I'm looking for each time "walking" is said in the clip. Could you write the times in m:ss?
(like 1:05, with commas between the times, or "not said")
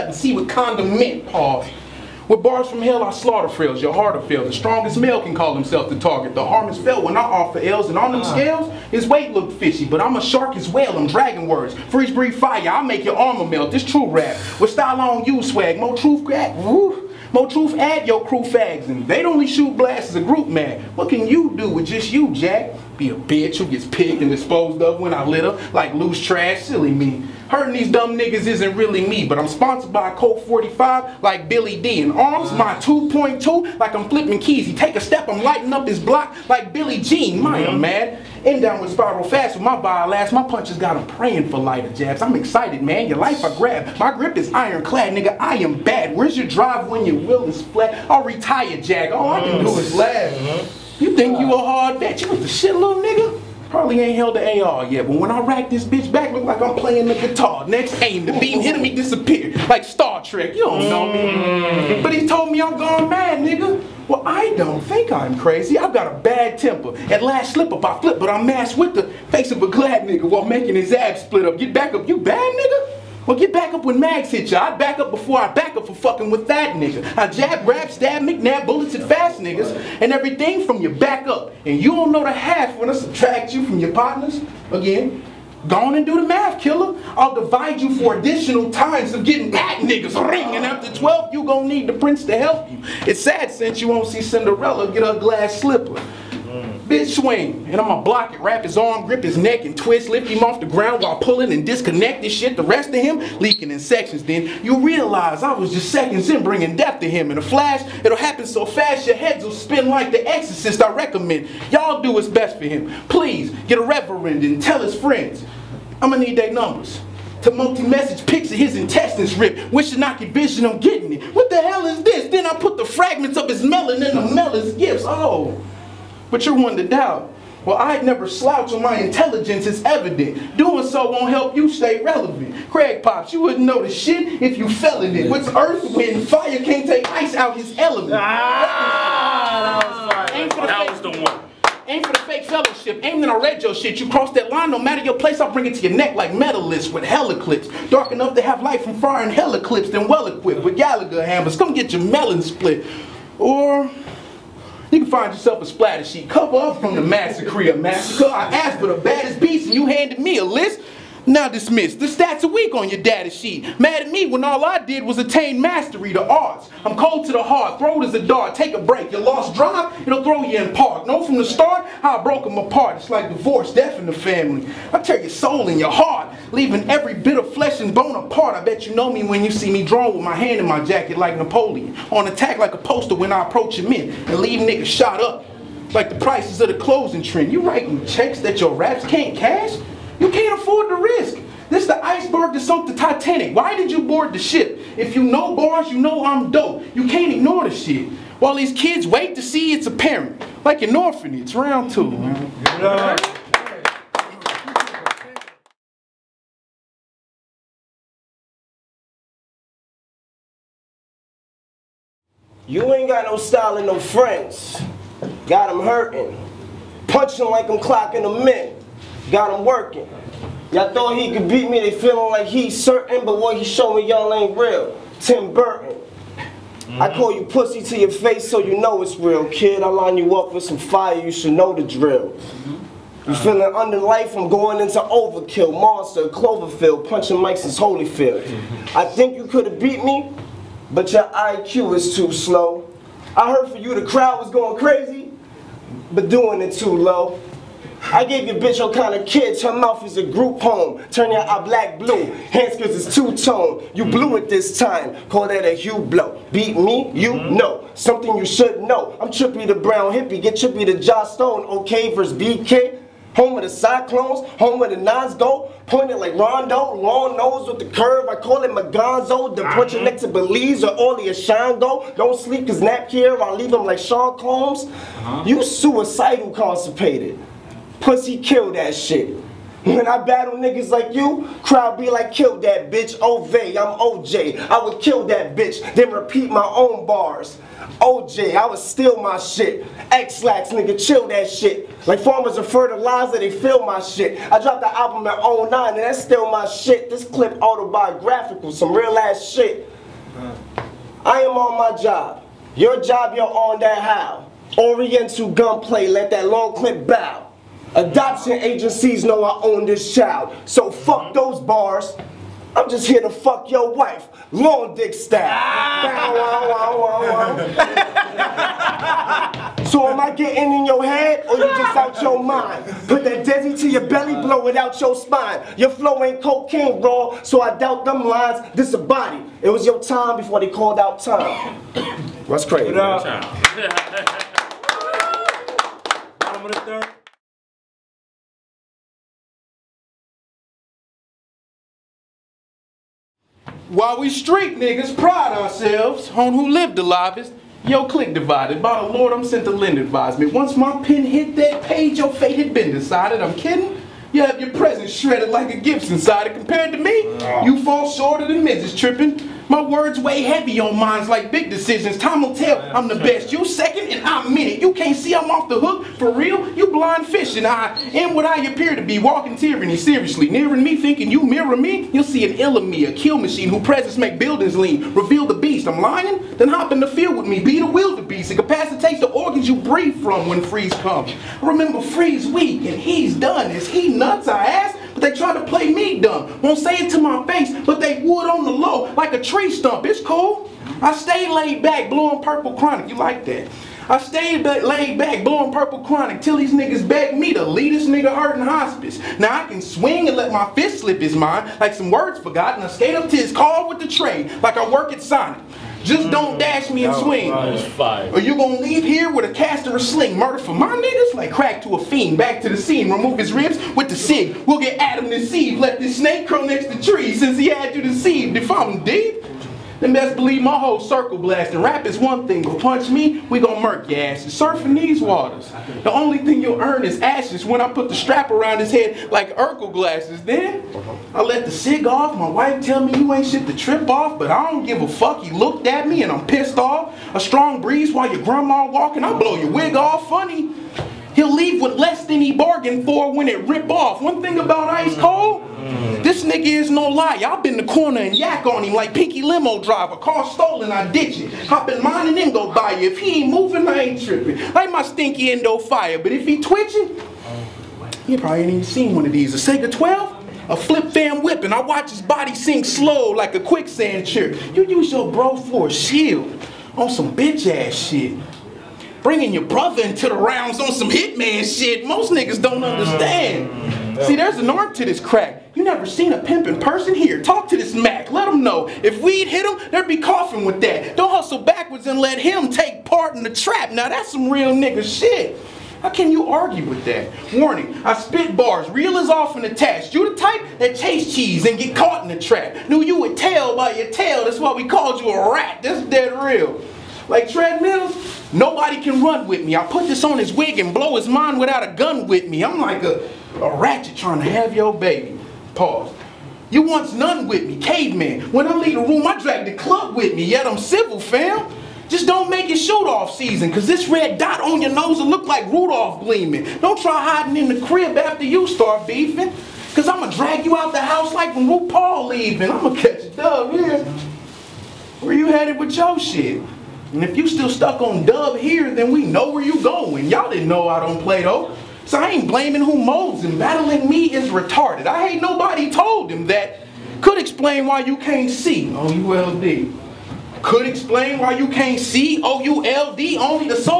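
6:09, 7:18.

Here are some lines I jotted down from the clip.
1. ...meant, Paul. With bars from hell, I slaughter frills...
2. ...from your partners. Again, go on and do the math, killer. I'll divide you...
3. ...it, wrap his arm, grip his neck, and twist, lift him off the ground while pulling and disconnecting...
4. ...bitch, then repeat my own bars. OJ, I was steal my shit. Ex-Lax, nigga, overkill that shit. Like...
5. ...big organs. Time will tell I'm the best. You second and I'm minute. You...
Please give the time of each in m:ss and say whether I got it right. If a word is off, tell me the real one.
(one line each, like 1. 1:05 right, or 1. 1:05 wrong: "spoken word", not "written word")
1. 0:00 right
2. 1:23 right
3. 1:38 right
4. 4:45 wrong: "chill", not "overkill"
5. 6:01 wrong: "decisions", not "organs".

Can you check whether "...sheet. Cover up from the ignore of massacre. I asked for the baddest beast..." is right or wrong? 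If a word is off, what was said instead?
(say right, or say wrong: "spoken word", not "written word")
wrong: "massacre", not "ignore".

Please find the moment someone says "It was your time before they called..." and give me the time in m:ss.
5:29.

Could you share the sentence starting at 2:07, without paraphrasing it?
Well, I'd never slouch on my intelligence it's evident.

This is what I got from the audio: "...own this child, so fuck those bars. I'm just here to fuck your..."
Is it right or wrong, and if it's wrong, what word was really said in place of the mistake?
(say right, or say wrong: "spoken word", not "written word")
right.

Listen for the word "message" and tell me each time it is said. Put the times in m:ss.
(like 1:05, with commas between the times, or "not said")
1:57.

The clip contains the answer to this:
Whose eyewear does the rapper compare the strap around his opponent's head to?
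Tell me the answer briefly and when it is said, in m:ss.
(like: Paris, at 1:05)
Urkel, at 7:09.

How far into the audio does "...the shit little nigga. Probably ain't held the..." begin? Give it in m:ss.
0:52.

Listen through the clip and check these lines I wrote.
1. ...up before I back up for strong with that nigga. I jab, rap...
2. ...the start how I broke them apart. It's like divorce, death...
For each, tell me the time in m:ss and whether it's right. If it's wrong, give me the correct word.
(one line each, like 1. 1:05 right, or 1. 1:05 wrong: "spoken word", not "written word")
1. 1:14 wrong: "fucking", not "strong"
2. 2:51 right.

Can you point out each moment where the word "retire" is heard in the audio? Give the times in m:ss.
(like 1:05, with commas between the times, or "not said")
0:48.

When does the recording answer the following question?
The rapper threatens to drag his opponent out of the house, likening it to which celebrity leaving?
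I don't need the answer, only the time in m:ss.
8:41.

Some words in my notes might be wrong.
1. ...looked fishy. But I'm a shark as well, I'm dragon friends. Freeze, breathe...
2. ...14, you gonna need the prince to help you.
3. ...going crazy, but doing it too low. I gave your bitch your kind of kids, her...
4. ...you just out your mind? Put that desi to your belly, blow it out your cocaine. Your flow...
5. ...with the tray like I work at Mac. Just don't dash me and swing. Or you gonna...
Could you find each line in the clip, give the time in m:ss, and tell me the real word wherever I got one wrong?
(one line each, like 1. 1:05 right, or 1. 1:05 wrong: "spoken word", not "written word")
1. 0:09 wrong: "words", not "friends"
2. 1:30 wrong: "12", not "14"
3. 4:04 right
4. 5:21 wrong: "spine", not "cocaine"
5. 6:43 wrong: "Sonic", not "Mac".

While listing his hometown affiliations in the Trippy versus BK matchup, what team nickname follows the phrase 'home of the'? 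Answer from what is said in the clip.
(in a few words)
Cyclones.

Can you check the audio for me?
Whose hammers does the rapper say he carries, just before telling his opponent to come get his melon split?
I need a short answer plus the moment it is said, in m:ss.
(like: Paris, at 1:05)
Gallagher, at 2:30.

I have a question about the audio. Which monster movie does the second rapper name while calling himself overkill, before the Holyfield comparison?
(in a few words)
Cloverfield.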